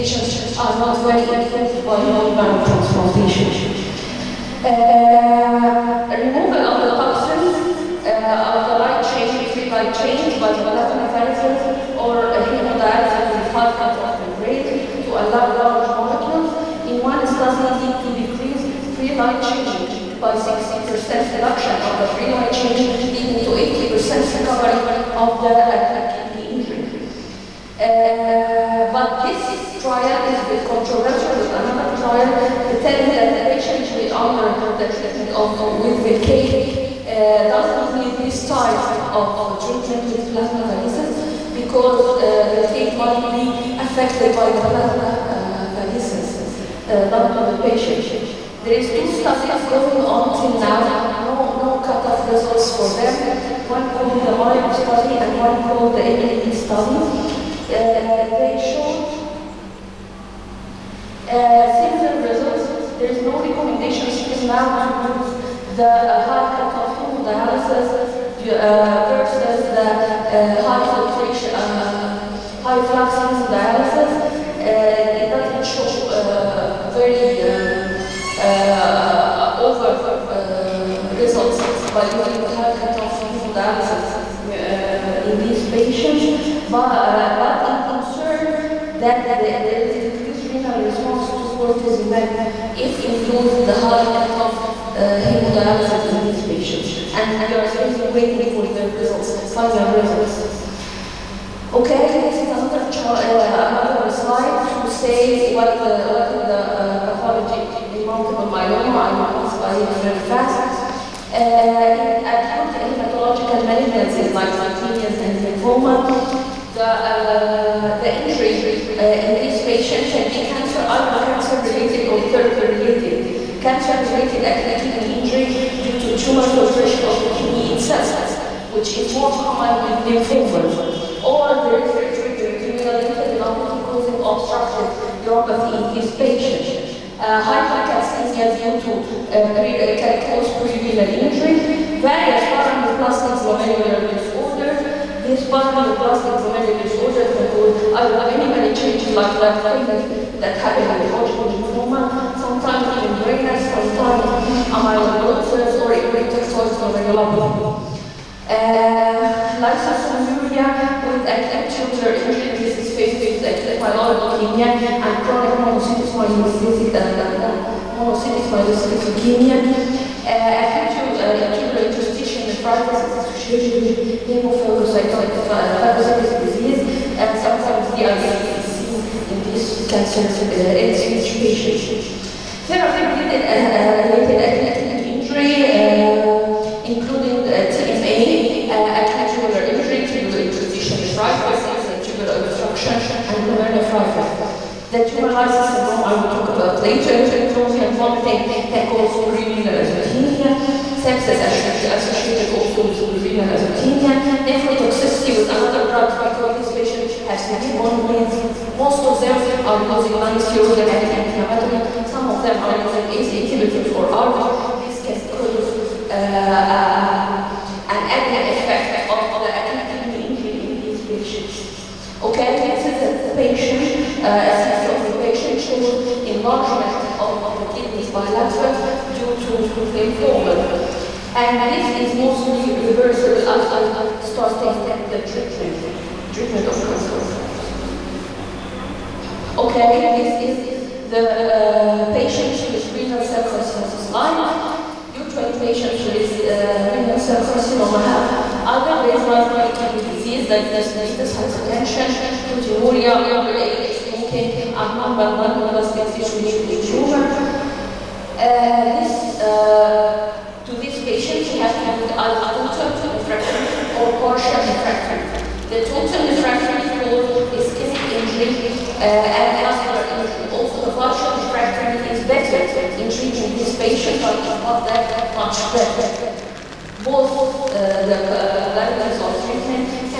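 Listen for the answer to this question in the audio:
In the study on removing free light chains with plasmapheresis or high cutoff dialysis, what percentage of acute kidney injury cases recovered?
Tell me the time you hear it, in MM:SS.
00:23.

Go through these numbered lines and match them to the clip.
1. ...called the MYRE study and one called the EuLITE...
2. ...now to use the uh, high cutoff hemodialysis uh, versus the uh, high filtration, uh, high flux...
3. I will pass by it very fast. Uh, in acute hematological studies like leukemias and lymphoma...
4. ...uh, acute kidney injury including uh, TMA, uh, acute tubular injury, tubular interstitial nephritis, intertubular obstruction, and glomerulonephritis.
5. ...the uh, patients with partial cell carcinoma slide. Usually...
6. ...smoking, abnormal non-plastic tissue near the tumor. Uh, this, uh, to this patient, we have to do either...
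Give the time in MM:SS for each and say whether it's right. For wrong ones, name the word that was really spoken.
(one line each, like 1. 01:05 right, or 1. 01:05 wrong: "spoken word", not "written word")
1. 00:53 right
2. 01:04 right
3. 01:48 wrong: "malignancies", not "studies"
4. 03:04 right
5. 04:01 wrong: "renal", not "partial"
6. 04:13 right.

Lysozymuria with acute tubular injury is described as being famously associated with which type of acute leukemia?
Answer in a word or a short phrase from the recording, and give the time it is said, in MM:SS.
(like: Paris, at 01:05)
Acute myeloid leukemia, at 02:43.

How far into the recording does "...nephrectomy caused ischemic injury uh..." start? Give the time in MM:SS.
04:26.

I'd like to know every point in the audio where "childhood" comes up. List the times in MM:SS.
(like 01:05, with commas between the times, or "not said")
not said.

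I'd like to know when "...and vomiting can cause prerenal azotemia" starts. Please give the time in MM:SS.
03:17.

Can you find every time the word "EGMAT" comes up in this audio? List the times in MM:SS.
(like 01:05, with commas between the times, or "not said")
not said.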